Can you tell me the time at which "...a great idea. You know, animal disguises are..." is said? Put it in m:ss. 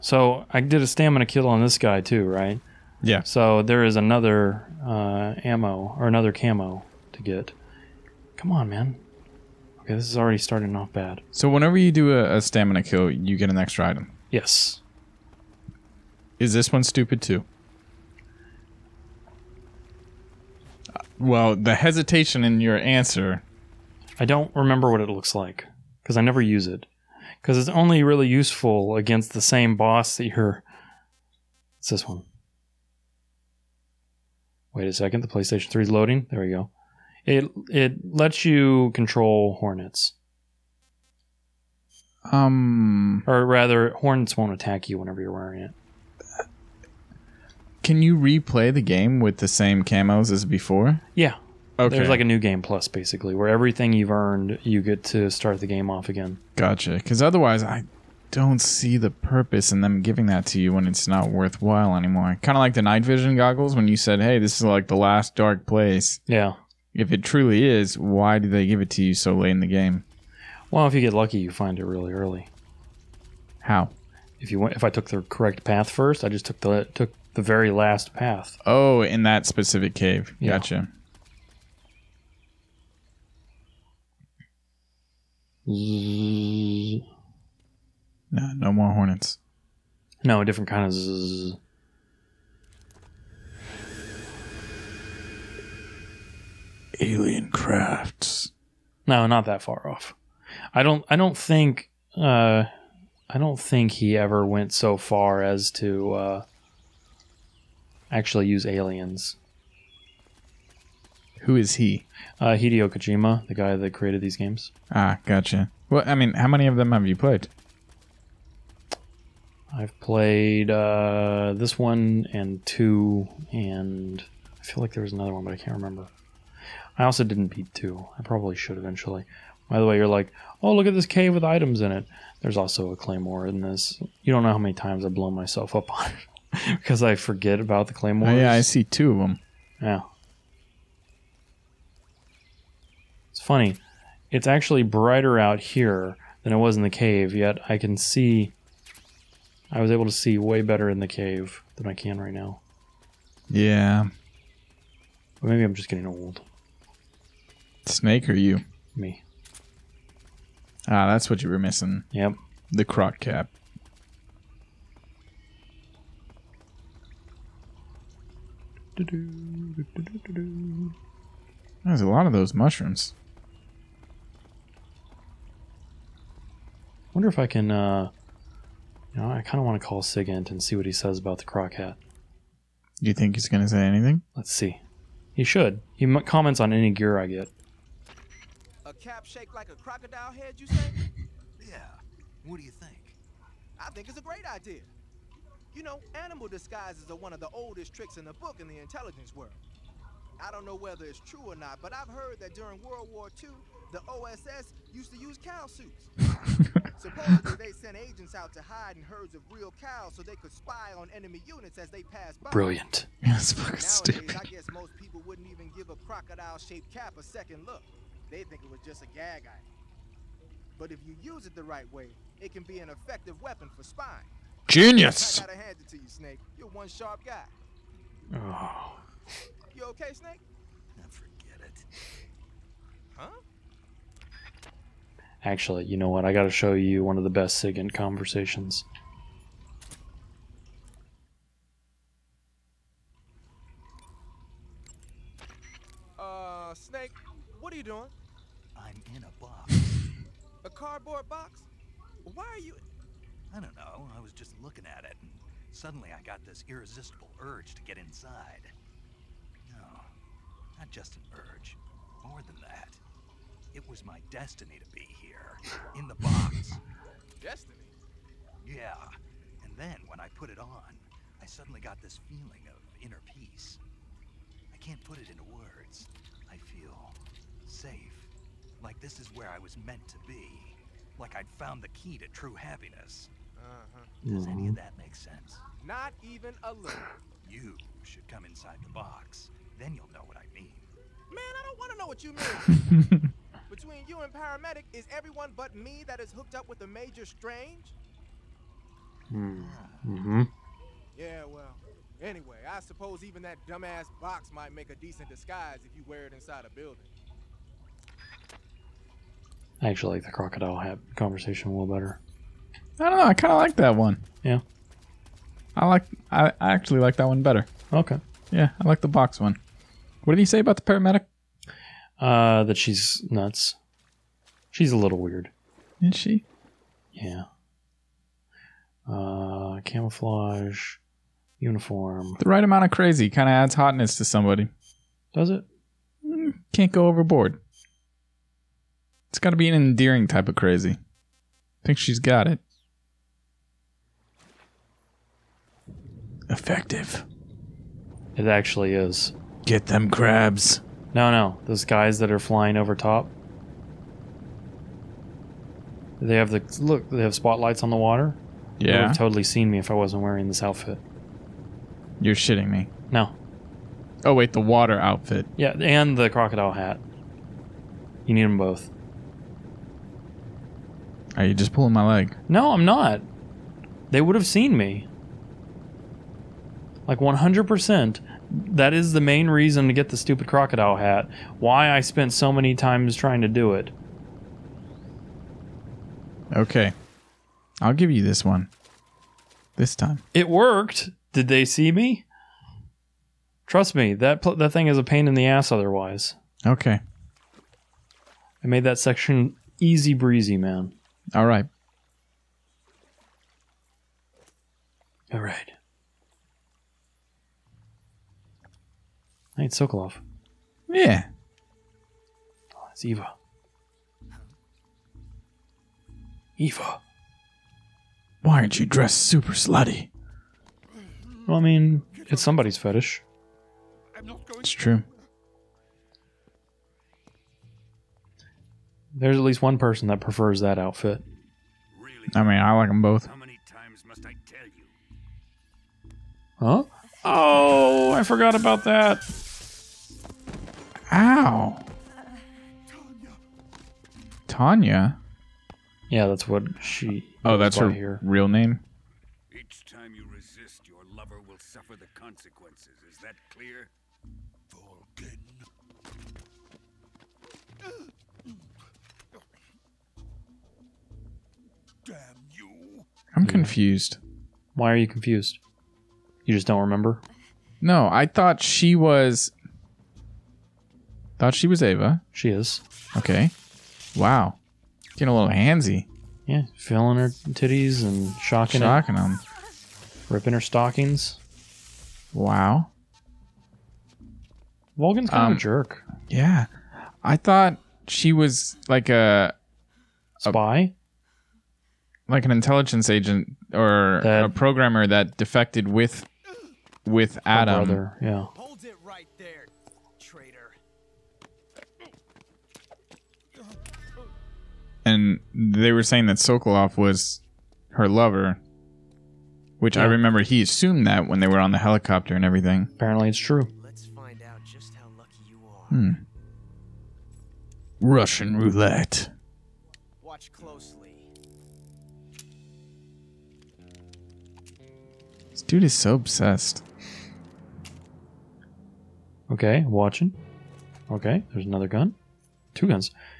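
3:14.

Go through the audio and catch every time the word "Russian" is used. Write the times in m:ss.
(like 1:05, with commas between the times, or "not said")
8:37.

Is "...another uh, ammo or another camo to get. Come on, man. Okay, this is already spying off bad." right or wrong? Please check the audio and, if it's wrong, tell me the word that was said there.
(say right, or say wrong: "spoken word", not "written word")
wrong: "starting", not "spying".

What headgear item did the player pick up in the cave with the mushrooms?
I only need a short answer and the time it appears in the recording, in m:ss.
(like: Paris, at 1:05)
The croc cap, at 2:42.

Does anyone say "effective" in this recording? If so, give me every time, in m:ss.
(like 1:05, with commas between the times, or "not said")
3:42, 5:46.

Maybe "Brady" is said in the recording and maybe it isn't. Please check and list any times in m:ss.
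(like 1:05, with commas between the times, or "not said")
not said.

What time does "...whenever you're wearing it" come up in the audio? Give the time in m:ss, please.
0:44.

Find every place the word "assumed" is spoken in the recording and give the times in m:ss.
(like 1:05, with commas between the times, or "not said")
8:30.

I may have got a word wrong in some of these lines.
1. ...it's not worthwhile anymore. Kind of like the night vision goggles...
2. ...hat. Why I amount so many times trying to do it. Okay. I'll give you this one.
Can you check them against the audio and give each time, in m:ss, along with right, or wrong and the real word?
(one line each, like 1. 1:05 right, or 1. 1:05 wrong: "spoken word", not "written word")
1. 1:00 right
2. 6:20 wrong: "spent", not "amount".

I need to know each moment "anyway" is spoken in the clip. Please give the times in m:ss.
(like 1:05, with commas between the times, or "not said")
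5:02.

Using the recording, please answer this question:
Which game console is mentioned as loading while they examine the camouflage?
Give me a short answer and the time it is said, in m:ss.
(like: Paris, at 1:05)
PlayStation 3, at 0:35.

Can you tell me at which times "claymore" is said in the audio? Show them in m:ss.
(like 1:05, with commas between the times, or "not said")
2:12, 2:17.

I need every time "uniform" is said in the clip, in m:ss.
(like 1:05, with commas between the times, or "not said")
5:31.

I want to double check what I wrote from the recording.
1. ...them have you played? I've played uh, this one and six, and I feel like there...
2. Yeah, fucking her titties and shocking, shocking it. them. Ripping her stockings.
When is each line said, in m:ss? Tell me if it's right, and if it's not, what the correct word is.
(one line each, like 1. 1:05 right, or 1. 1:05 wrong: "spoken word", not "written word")
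1. 1:56 wrong: "two", not "six"
2. 7:56 wrong: "filling", not "fucking".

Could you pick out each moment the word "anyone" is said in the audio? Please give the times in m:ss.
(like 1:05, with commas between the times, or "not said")
not said.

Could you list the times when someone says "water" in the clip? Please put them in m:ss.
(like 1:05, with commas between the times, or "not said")
5:57, 6:04.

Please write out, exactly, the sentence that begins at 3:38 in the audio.
They think it was just a gag item.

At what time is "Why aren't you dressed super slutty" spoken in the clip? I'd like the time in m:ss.
6:58.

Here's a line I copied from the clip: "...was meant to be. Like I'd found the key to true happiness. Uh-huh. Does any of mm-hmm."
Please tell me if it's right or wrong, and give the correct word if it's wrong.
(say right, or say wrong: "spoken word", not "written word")
right.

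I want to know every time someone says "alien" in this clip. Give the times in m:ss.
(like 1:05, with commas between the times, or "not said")
1:37, 1:48.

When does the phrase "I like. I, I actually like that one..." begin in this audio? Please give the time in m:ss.
5:15.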